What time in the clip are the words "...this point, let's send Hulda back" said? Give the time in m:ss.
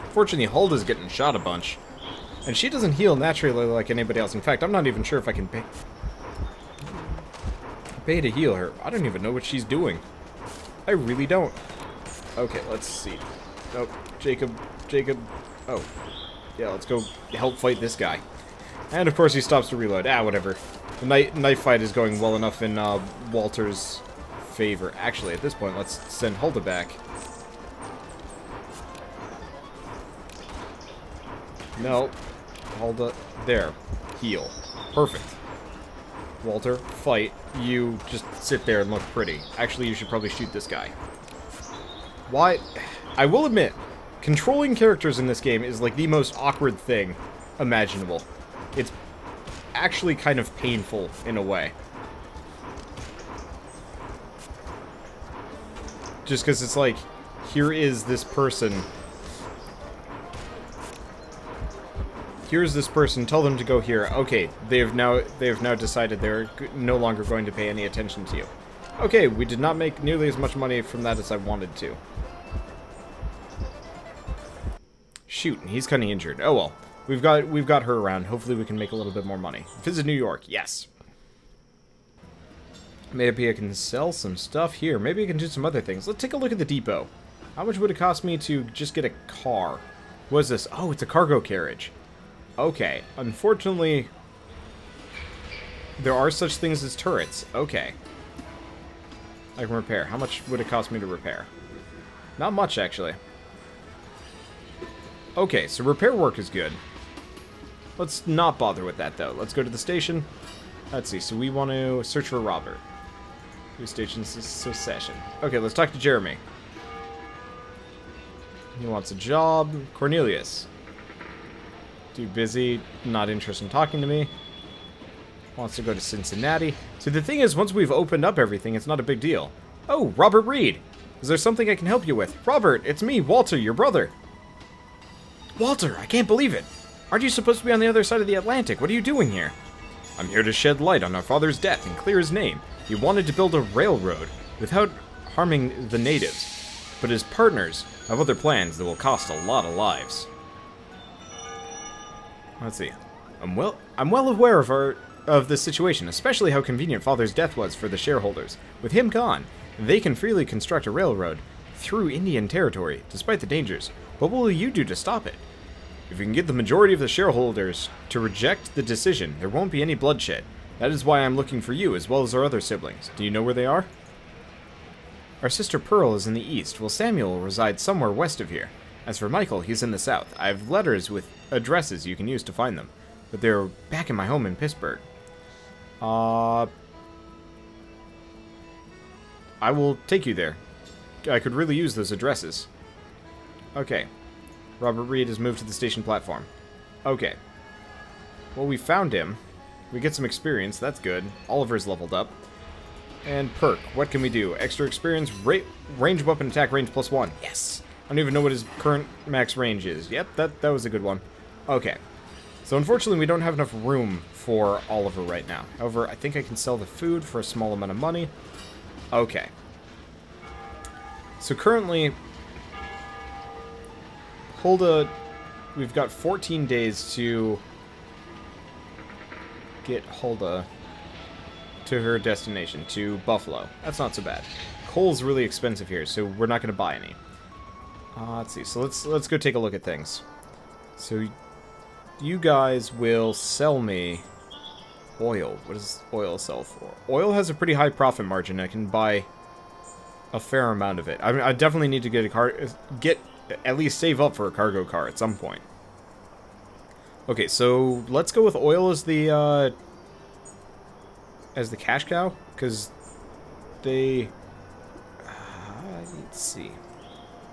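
0:25.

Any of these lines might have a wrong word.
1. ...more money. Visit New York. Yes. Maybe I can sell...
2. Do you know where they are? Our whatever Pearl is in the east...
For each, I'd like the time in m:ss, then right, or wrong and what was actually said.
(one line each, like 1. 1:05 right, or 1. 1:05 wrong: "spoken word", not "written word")
1. 1:19 right
2. 2:53 wrong: "sister", not "whatever".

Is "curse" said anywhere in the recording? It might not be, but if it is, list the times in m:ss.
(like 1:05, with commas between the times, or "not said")
not said.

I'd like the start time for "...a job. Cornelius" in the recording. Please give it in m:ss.
1:59.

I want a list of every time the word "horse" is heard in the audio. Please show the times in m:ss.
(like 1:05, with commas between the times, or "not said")
not said.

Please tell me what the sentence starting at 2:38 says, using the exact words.
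With him gone, they can freely construct a railroad through Indian territory, despite the dangers.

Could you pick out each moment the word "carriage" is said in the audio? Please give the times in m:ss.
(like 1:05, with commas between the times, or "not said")
1:31.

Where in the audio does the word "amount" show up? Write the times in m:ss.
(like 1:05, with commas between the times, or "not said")
3:37, 4:10.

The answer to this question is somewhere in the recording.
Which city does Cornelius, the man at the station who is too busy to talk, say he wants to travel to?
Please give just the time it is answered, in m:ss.
2:06.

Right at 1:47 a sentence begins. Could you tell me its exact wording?
Let's not bother with that, though.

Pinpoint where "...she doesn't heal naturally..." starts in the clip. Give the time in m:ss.
0:02.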